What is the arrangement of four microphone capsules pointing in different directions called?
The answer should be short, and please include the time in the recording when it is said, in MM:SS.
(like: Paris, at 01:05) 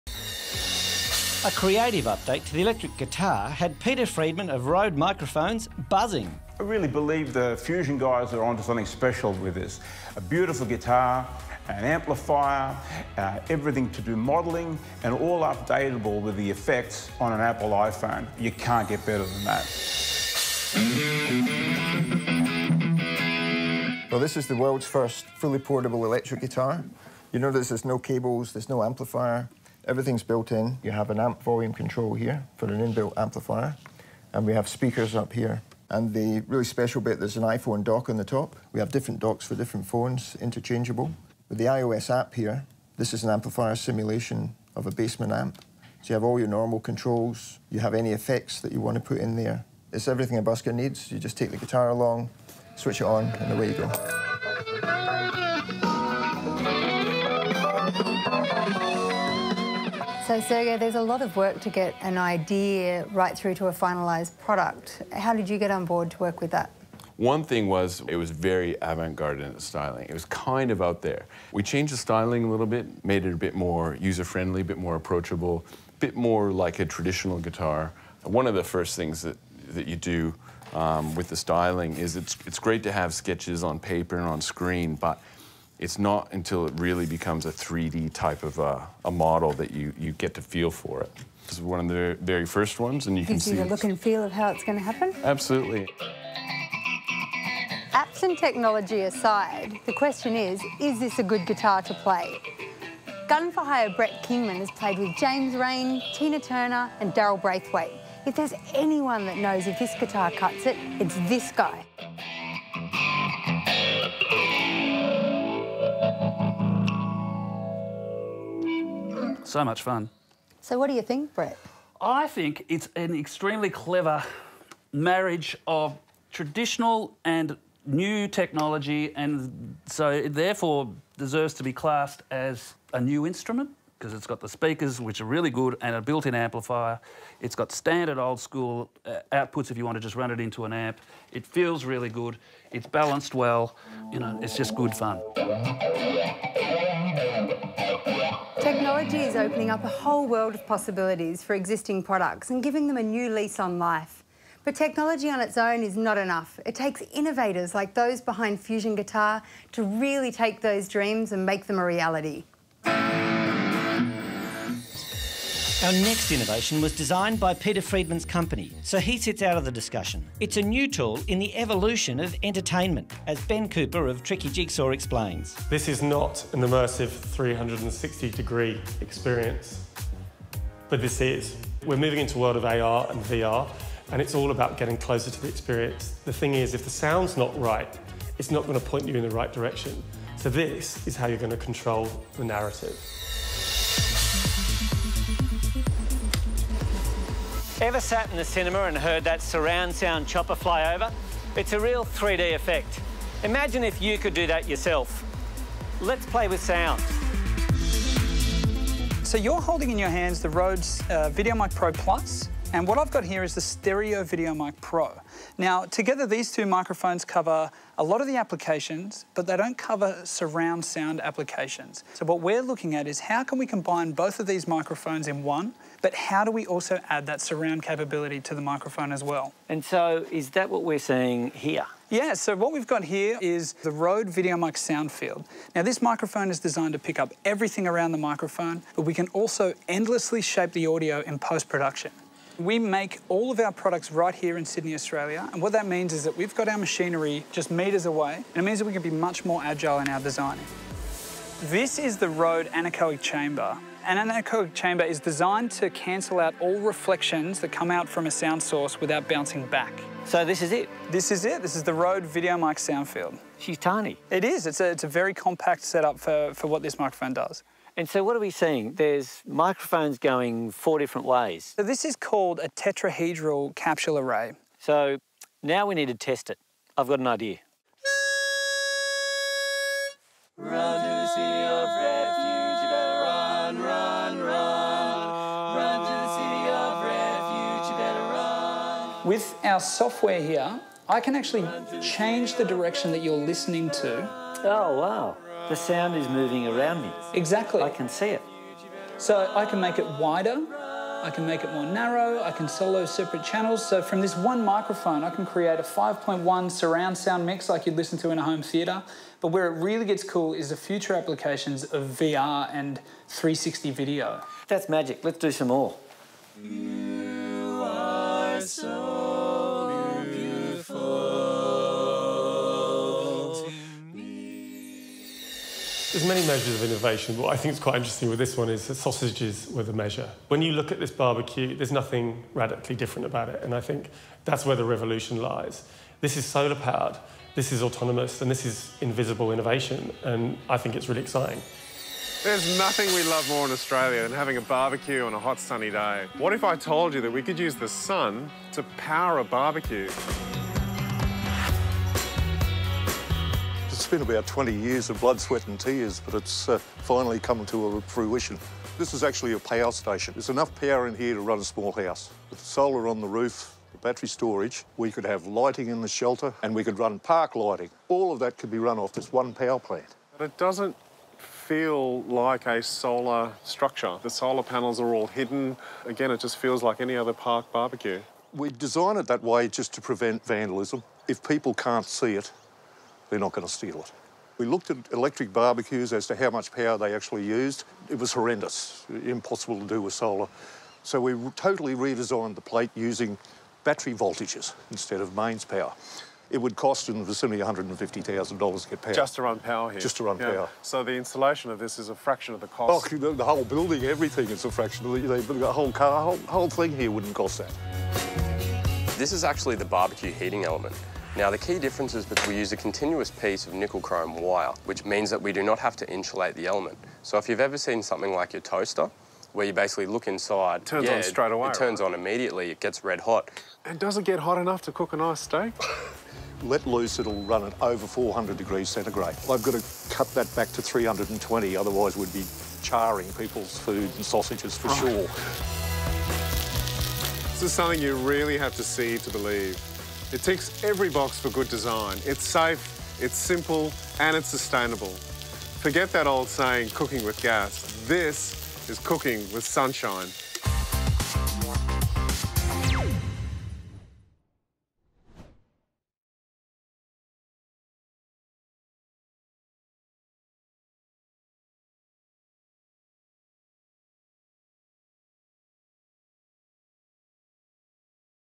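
tetrahedral capsule array, at 04:32.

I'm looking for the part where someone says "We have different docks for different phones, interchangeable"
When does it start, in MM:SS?
00:38.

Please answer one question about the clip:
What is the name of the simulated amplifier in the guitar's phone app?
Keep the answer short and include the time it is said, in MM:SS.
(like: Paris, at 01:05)
basement amp, at 00:44.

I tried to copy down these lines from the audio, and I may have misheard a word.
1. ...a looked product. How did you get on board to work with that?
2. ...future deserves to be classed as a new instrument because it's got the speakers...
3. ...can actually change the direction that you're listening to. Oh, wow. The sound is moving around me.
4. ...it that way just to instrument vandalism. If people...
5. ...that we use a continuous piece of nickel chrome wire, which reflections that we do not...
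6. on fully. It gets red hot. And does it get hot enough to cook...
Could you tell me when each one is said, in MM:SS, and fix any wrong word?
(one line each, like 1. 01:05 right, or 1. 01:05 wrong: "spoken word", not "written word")
1. 01:03 wrong: "finalised", not "looked"
2. 02:10 wrong: "therefore", not "future"
3. 04:51 right
4. 06:19 wrong: "prevent", not "instrument"
5. 06:52 wrong: "means", not "reflections"
6. 07:02 wrong: "immediately", not "fully".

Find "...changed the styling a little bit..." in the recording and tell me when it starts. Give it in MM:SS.
01:11.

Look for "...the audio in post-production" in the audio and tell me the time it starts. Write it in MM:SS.
04:00.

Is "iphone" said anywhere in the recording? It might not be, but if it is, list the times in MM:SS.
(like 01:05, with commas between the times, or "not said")
00:17, 00:37.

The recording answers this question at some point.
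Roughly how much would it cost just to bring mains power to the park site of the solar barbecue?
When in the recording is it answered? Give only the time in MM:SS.
06:37.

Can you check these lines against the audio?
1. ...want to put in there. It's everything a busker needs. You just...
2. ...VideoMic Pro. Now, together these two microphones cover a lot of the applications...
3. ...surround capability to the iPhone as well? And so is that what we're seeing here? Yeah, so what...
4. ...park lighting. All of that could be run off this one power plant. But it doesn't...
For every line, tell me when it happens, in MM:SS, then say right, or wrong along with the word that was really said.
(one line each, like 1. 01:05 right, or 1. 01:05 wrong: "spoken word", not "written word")
1. 00:48 right
2. 03:34 right
3. 03:47 wrong: "microphone", not "iPhone"
4. 06:07 right.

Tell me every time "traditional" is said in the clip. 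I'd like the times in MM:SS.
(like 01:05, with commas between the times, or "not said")
01:16, 02:06.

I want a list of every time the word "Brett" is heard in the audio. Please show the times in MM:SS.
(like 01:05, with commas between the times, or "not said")
01:43, 02:01.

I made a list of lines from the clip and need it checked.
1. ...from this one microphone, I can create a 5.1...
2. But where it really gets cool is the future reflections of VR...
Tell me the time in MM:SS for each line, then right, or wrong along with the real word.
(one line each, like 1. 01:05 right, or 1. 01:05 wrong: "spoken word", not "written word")
1. 05:04 right
2. 05:09 wrong: "applications", not "reflections".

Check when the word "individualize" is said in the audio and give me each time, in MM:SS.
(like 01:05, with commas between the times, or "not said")
not said.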